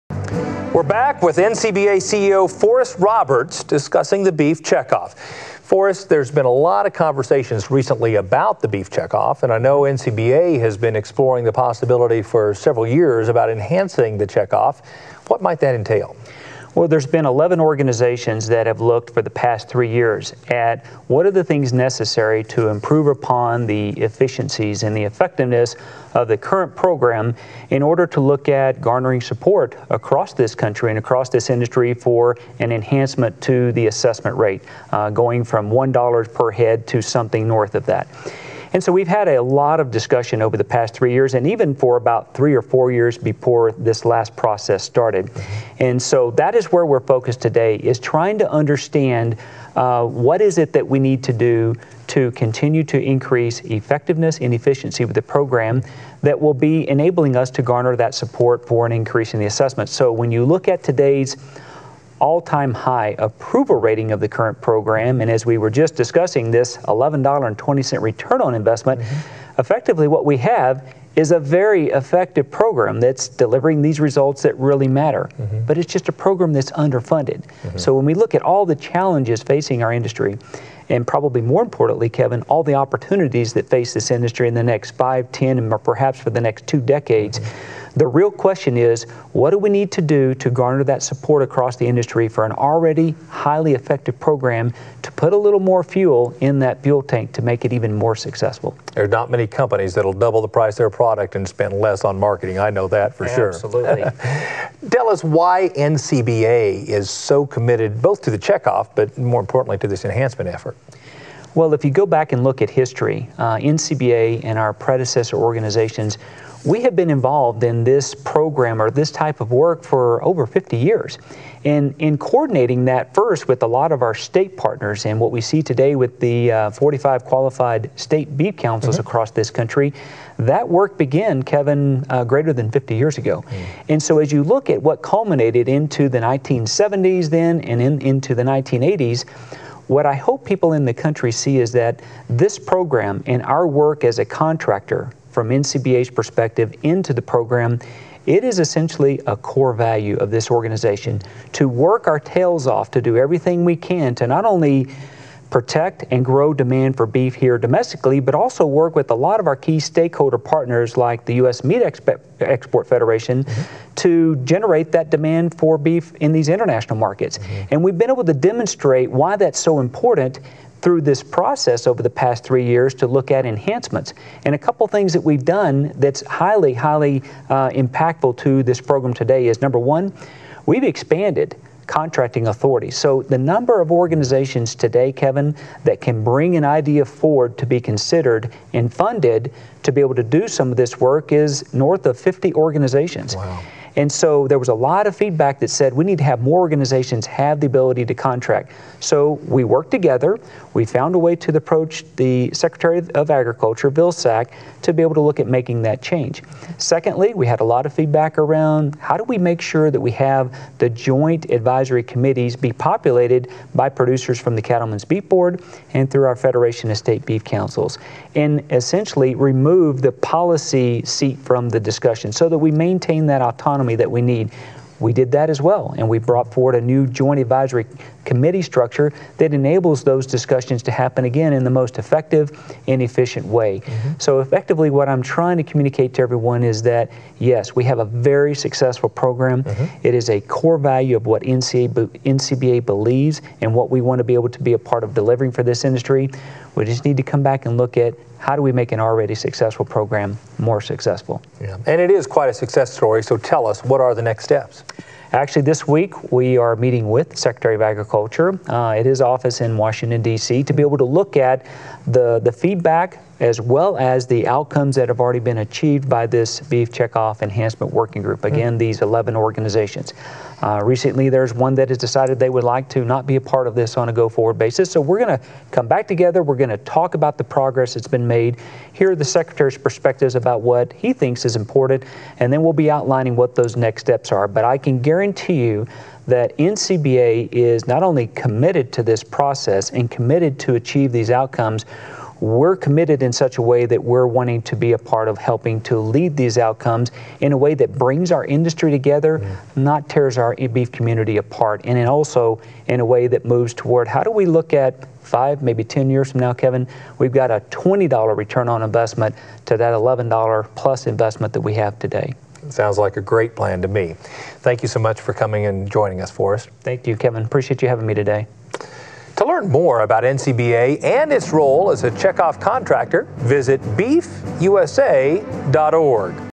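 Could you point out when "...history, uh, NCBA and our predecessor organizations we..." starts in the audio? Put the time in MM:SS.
01:52.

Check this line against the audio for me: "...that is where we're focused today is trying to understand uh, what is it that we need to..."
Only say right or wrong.
right.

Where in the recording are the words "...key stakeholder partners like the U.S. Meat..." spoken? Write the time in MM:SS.
02:39.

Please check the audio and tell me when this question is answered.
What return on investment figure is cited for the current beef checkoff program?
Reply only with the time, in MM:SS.
01:06.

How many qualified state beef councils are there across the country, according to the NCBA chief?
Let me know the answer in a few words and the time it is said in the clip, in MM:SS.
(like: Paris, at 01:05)
45, at 02:06.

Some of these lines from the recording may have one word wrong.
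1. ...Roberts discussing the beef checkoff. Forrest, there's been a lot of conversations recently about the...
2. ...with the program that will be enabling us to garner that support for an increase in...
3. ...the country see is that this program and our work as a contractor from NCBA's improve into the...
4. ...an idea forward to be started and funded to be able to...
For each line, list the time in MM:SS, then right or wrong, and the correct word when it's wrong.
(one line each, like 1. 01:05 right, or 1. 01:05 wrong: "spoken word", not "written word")
1. 00:02 right
2. 00:55 right
3. 02:20 wrong: "perspective", not "improve"
4. 03:06 wrong: "considered", not "started".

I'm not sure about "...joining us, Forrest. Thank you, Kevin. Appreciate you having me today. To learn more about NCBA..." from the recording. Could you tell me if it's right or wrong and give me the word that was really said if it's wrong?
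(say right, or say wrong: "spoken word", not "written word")
right.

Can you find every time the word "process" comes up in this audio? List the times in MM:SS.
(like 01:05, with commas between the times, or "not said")
00:44, 02:51, 04:49.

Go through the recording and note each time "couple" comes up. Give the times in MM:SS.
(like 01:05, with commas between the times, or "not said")
02:54.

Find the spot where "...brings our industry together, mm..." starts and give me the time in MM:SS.
04:57.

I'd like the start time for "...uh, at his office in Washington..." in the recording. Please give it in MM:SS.
04:18.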